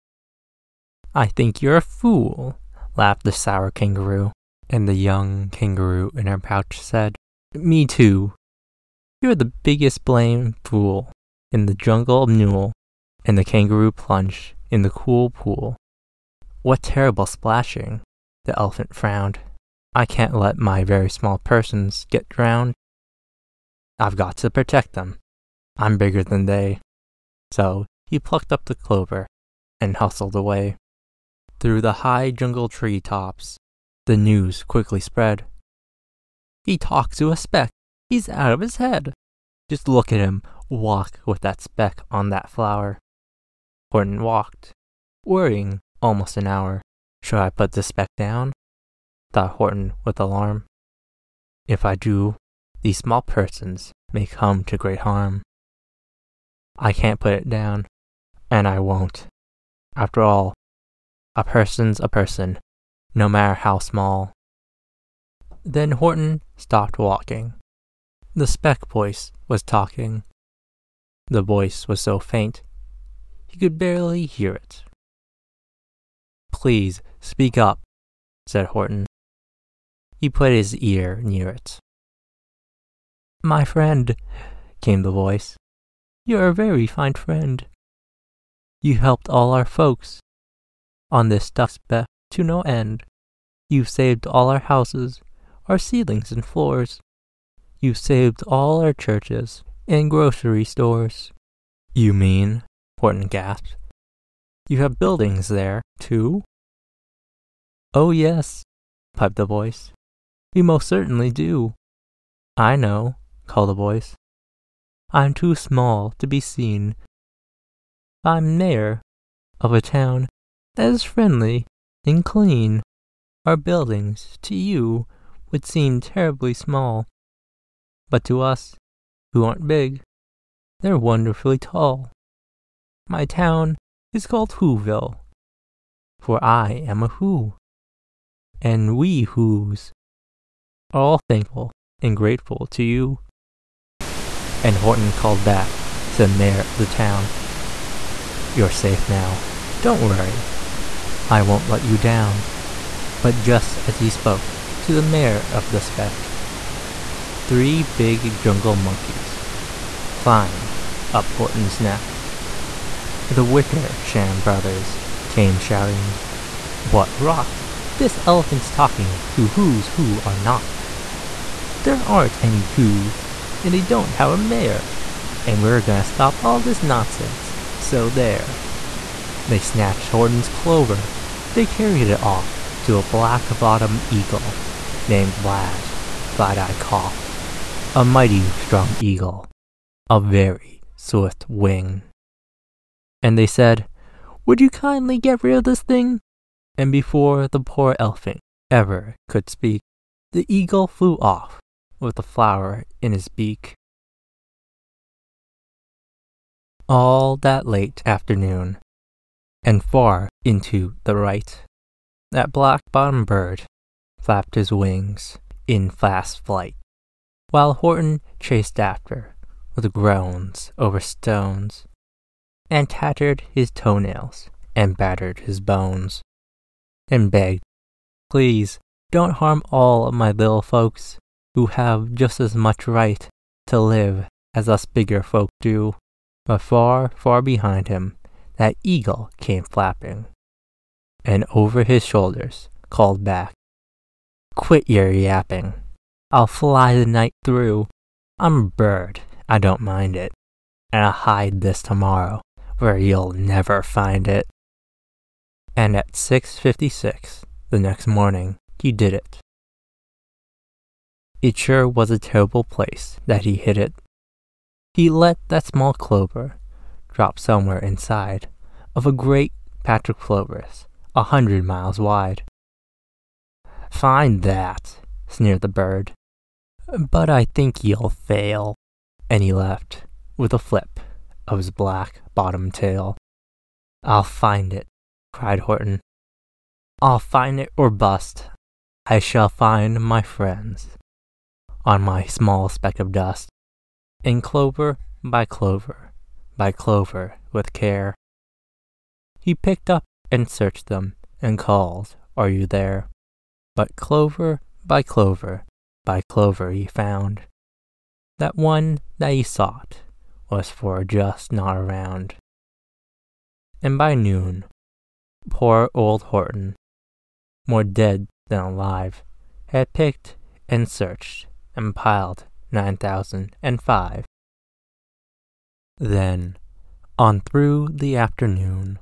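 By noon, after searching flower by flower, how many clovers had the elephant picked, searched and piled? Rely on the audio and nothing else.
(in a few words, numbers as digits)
9005.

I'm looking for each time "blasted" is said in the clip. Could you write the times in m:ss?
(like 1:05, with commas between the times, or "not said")
not said.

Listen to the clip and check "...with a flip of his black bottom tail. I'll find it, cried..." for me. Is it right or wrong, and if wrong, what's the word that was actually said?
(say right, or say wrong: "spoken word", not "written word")
right.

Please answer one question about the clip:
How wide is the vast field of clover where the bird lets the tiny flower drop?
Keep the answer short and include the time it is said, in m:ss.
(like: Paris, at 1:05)
100 miles, at 4:31.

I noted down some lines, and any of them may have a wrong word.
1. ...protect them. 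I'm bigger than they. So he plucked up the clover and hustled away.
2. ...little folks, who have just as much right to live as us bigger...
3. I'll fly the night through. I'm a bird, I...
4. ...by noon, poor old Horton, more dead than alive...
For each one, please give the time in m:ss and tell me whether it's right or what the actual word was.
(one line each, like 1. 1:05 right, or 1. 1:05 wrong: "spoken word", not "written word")
1. 0:24 right
2. 3:50 right
3. 4:06 right
4. 5:13 right.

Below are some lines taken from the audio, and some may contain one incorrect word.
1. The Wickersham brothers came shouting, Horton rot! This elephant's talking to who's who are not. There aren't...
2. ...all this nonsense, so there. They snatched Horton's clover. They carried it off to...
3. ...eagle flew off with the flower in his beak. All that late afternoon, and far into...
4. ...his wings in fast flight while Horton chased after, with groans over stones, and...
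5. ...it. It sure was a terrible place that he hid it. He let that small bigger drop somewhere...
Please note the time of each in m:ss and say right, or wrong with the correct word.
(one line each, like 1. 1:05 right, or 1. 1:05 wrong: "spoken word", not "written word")
1. 2:43 wrong: "What", not "Horton"
2. 2:56 right
3. 3:20 right
4. 3:34 right
5. 4:19 wrong: "clover", not "bigger".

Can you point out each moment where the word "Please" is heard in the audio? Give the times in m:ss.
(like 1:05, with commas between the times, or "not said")
1:16, 3:48.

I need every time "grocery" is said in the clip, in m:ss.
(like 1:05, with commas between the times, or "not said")
1:40.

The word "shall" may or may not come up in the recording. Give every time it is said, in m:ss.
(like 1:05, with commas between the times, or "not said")
4:49.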